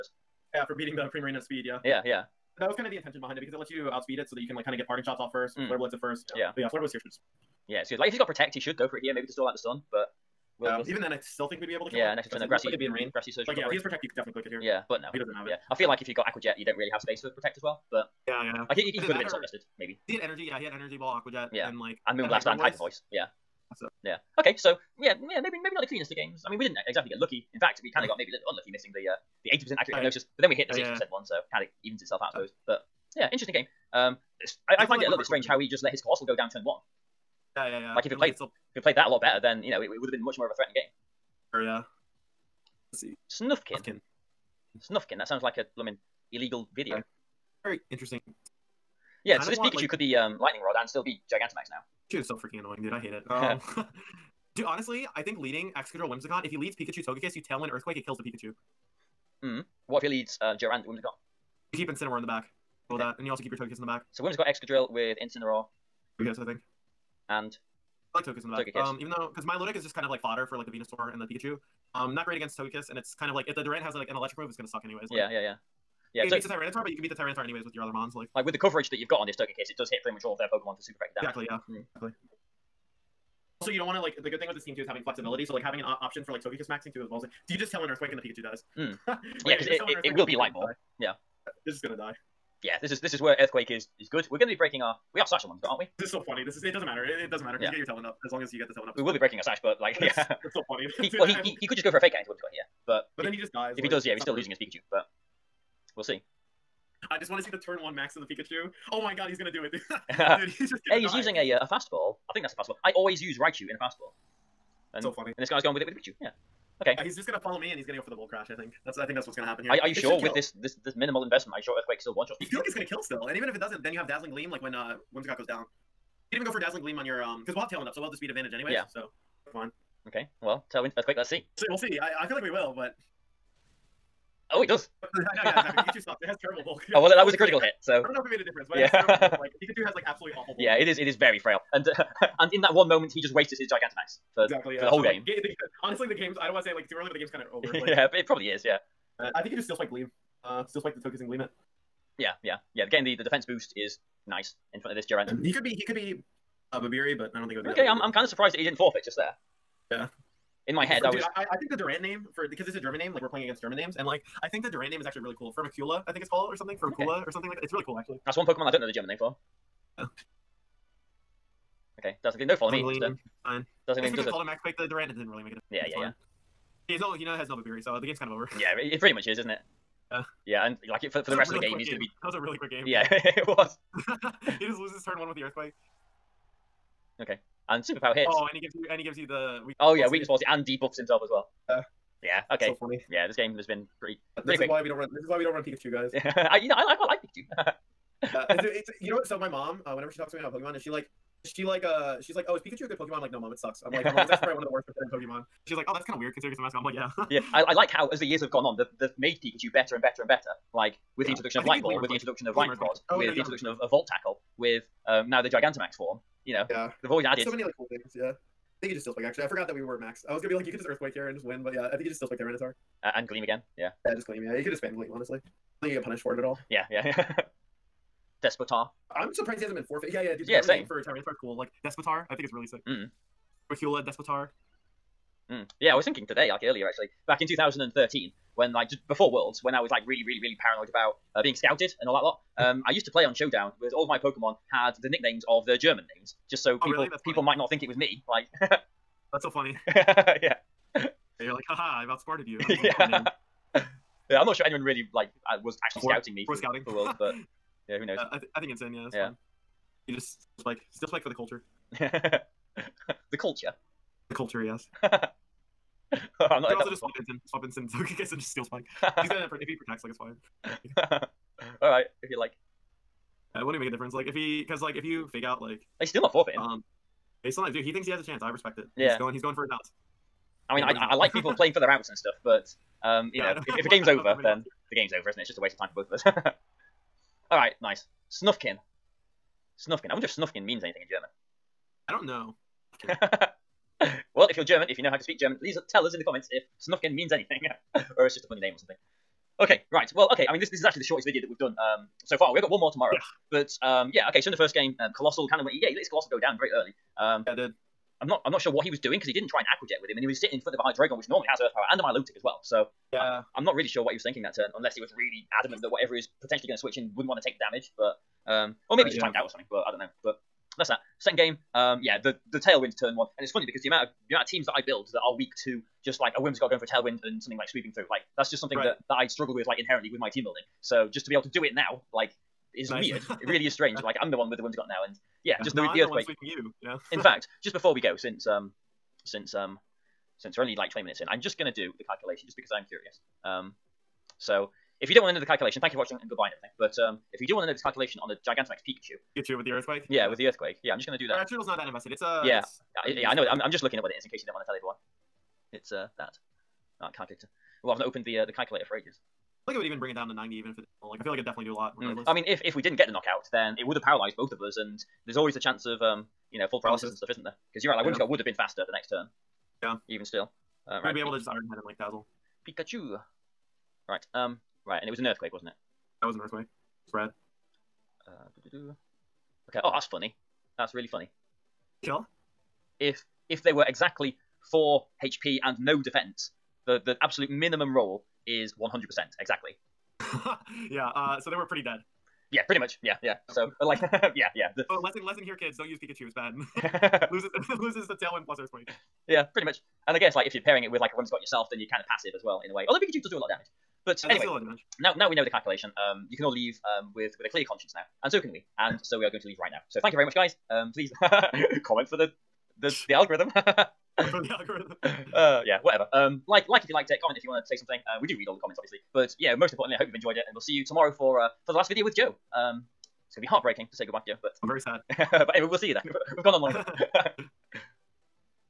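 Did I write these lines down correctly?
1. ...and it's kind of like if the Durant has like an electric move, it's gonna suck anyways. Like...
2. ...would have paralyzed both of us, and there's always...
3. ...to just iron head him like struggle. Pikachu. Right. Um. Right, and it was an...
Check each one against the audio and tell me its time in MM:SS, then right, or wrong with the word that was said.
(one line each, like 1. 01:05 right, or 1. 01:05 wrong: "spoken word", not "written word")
1. 01:12 right
2. 06:03 right
3. 06:11 wrong: "dazzle", not "struggle".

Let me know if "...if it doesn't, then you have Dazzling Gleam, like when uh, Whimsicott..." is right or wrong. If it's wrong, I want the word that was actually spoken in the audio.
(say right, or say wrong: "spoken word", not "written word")
right.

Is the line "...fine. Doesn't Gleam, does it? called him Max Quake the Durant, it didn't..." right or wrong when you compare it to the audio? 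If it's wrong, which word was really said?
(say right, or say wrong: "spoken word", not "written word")
right.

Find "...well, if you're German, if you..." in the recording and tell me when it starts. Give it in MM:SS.
04:54.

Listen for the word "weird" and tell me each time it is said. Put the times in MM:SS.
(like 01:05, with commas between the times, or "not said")
03:26, 05:33.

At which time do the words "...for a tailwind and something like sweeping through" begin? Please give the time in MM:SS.
05:26.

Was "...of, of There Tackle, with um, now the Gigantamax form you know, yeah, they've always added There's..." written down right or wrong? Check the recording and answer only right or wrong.
wrong.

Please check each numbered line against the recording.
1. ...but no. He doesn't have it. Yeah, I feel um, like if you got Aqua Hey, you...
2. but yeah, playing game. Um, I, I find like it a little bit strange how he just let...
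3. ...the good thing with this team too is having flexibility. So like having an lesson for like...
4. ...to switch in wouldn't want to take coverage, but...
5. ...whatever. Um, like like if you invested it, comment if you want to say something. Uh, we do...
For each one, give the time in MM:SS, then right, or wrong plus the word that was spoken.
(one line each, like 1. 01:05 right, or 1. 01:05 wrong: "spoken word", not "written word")
1. 00:14 wrong: "Jet", not "Hey"
2. 00:32 wrong: "interesting", not "playing"
3. 01:24 wrong: "option", not "lesson"
4. 05:16 wrong: "damage", not "coverage"
5. 06:55 wrong: "liked", not "invested".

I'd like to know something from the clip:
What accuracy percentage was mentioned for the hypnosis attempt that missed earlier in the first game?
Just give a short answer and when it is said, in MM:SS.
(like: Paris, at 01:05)
80, at 00:29.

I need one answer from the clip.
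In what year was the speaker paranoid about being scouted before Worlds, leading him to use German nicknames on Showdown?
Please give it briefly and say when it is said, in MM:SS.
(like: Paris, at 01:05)
2013, at 03:57.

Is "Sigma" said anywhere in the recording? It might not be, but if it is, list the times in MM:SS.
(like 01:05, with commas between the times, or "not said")
not said.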